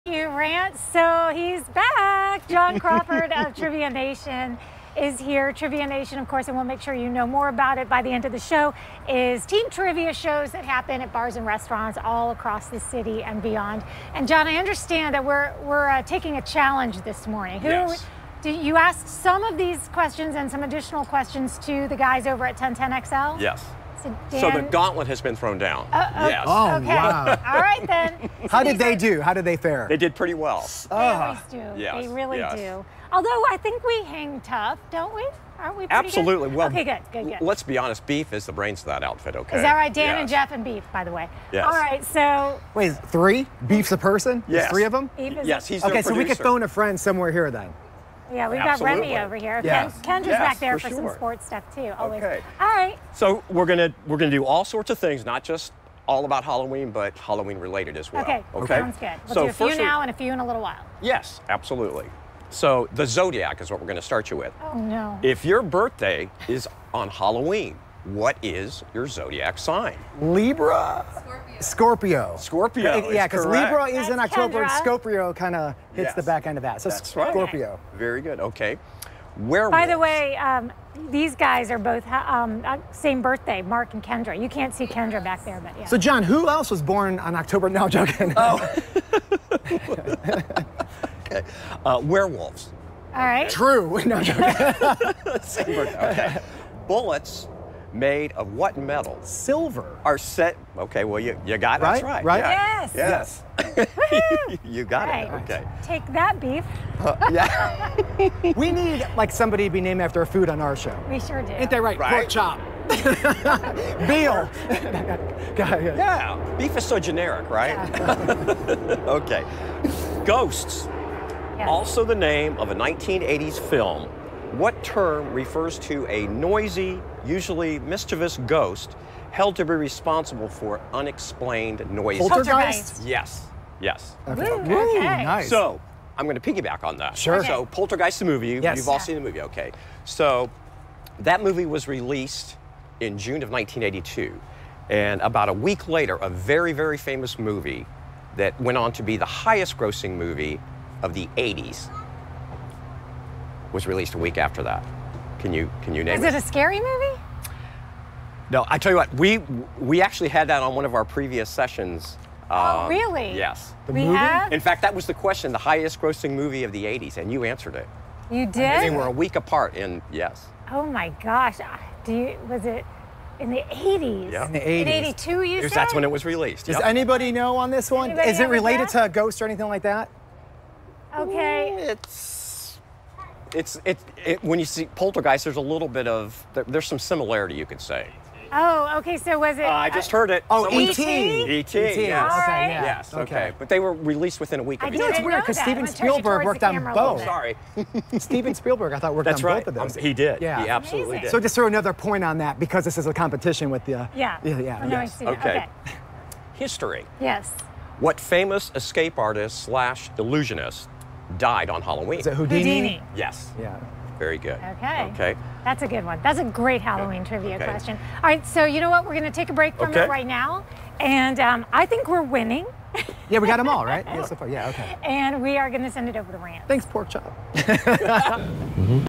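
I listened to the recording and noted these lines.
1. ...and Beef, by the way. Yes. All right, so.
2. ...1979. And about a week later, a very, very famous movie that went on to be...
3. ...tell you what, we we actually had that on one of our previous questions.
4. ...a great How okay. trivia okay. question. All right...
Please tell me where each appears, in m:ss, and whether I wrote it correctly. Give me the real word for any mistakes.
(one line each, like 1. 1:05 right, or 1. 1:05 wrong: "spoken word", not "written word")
1. 0:40 right
2. 2:23 wrong: "1982", not "1979"
3. 2:38 wrong: "sessions", not "questions"
4. 3:36 wrong: "Halloween", not "How".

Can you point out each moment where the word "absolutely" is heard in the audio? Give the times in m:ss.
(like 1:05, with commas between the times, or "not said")
0:35, 0:48, 1:01, 3:20.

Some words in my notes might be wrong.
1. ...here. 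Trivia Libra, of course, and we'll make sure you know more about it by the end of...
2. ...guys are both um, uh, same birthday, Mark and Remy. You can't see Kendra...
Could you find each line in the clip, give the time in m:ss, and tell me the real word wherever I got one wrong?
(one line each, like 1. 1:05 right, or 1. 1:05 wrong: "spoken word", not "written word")
1. 0:05 wrong: "Nation", not "Libra"
2. 1:21 wrong: "Kendra", not "Remy".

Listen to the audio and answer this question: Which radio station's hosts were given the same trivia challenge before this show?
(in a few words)
1010XL.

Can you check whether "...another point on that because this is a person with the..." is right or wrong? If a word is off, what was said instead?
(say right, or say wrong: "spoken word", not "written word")
wrong: "competition", not "person".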